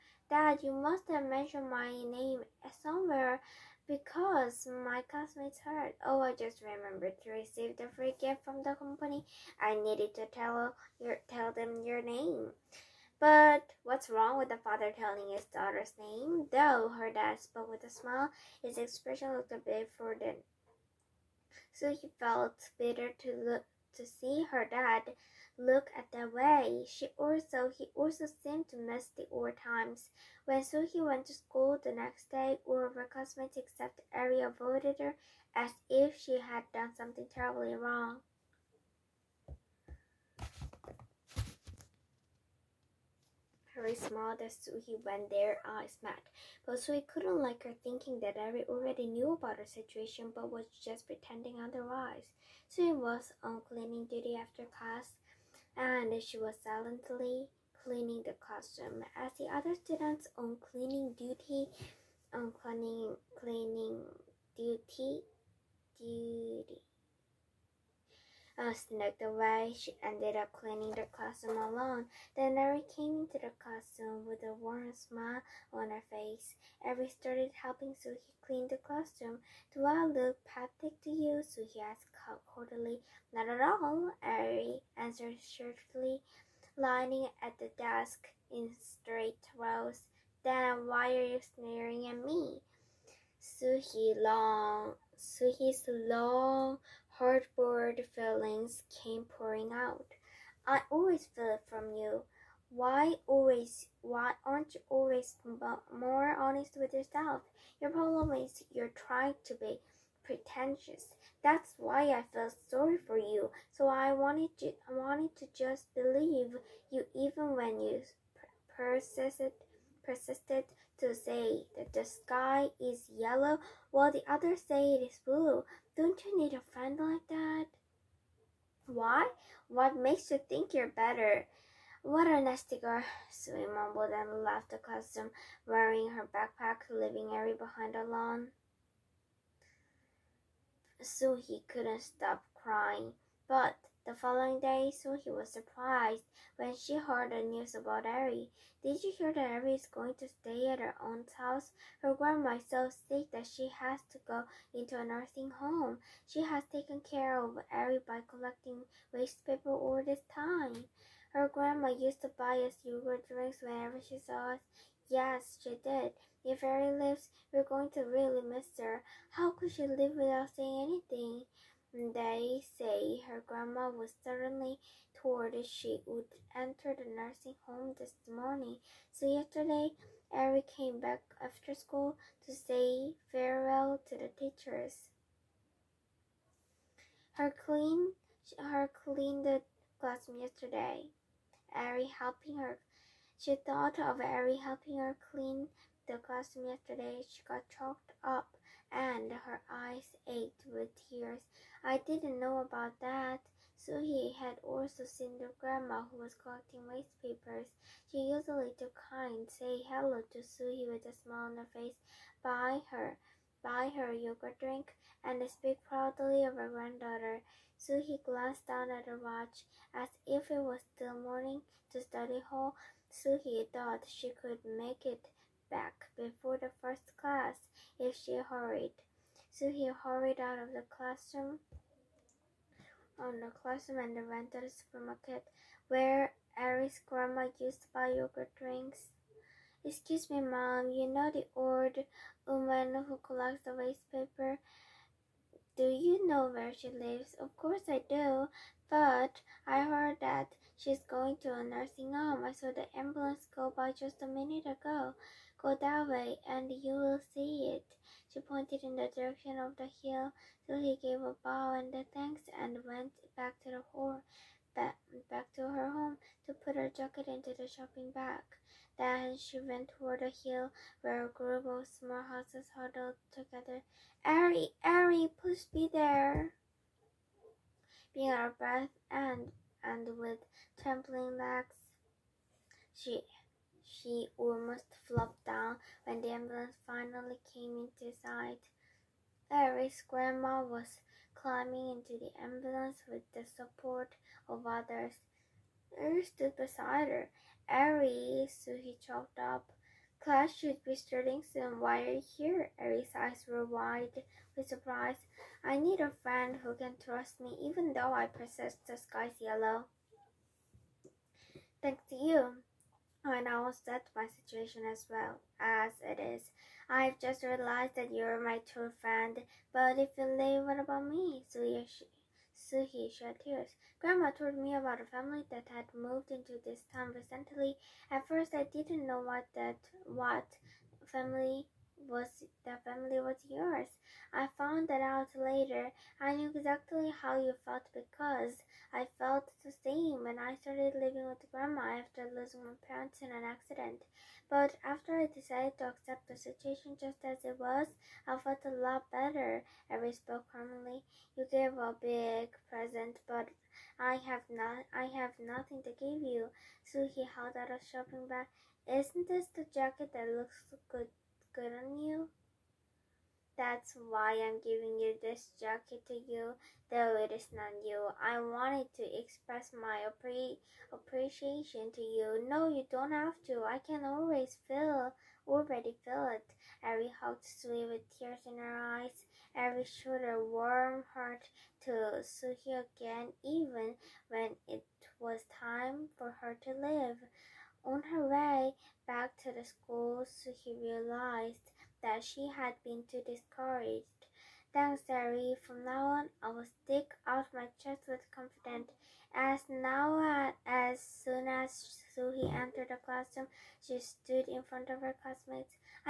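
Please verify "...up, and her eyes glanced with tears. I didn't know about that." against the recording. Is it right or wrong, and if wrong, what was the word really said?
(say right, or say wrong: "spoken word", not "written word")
wrong: "ached", not "glanced".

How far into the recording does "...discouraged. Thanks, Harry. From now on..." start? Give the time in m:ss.
6:33.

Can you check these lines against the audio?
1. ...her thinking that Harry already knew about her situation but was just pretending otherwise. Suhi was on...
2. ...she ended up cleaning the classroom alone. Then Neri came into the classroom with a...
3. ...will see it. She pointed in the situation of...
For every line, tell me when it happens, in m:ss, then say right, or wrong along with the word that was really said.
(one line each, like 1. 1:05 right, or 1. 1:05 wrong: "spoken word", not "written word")
1. 0:47 right
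2. 1:09 right
3. 4:16 wrong: "direction", not "situation".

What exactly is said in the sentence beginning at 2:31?
Her grandma is so sick that she has to go into a nursing home.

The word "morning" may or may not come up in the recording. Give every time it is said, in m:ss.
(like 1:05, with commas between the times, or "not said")
2:58, 3:41.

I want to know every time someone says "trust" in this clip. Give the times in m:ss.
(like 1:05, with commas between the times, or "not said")
5:07.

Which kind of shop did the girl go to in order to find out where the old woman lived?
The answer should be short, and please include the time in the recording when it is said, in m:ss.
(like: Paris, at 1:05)
Supermarket, at 3:54.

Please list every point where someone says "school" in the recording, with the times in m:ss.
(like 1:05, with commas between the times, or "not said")
0:31, 3:01, 6:29.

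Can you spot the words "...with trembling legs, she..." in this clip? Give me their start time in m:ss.
4:40.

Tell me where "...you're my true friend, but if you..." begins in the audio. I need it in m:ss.
5:18.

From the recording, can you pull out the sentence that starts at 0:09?
I needed to tell your, tell them your name.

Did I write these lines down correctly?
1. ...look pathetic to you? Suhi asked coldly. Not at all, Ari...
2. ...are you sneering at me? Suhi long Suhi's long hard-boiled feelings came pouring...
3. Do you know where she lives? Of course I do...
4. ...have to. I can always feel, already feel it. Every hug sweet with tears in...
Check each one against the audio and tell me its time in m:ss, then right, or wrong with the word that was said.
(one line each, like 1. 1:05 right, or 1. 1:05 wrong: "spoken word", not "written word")
1. 1:20 wrong: "Eri", not "Ari"
2. 1:31 right
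3. 4:05 right
4. 6:13 right.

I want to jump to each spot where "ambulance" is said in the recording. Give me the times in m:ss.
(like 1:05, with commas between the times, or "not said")
4:12, 4:46, 4:52.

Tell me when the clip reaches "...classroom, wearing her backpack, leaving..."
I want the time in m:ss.
2:14.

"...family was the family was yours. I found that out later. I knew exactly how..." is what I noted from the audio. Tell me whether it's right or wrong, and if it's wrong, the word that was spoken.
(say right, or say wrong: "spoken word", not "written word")
right.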